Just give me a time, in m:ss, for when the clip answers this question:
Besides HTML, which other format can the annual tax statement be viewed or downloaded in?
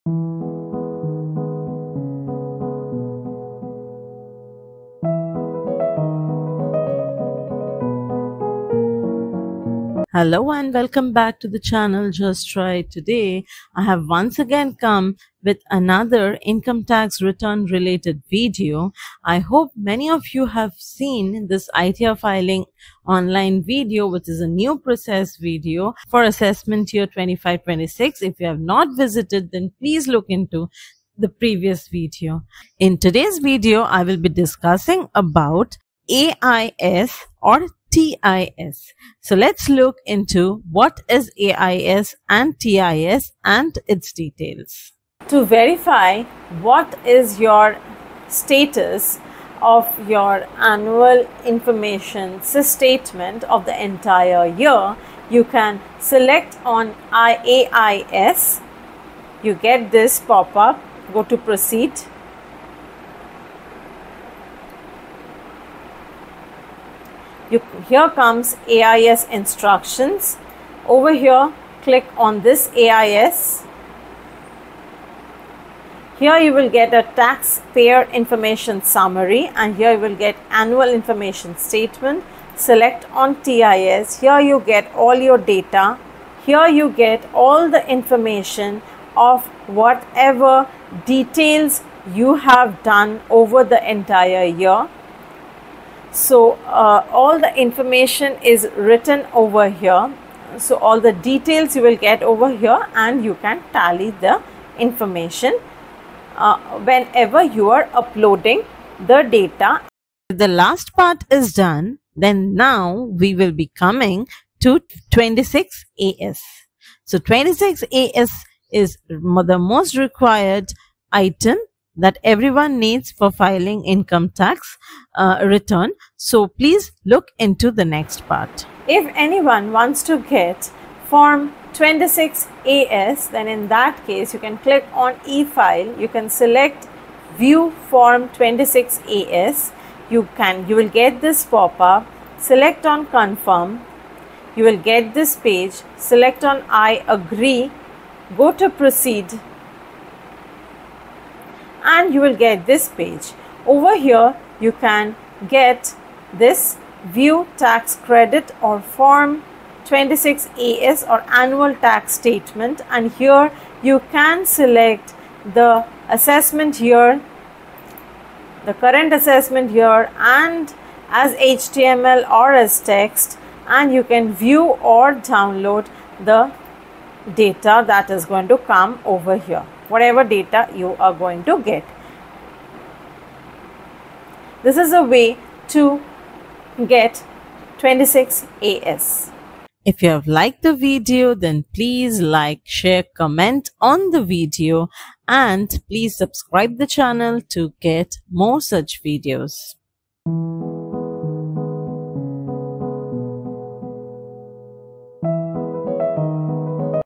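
2:52.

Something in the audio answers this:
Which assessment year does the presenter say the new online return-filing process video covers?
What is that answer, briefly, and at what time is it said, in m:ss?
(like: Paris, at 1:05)
2526, at 0:26.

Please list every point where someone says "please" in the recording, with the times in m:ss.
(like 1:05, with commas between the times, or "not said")
0:29, 2:06, 3:11, 3:15.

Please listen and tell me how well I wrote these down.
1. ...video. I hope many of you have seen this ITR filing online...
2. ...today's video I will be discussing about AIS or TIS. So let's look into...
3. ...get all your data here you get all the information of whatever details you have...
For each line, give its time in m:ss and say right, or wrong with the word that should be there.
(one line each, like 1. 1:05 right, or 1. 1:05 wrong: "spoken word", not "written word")
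1. 0:18 right
2. 0:32 right
3. 1:24 right.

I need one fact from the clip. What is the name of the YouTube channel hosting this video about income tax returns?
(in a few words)
Just Trry Today.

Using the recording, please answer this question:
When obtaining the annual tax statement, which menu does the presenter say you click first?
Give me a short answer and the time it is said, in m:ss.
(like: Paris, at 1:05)
e-file, at 2:15.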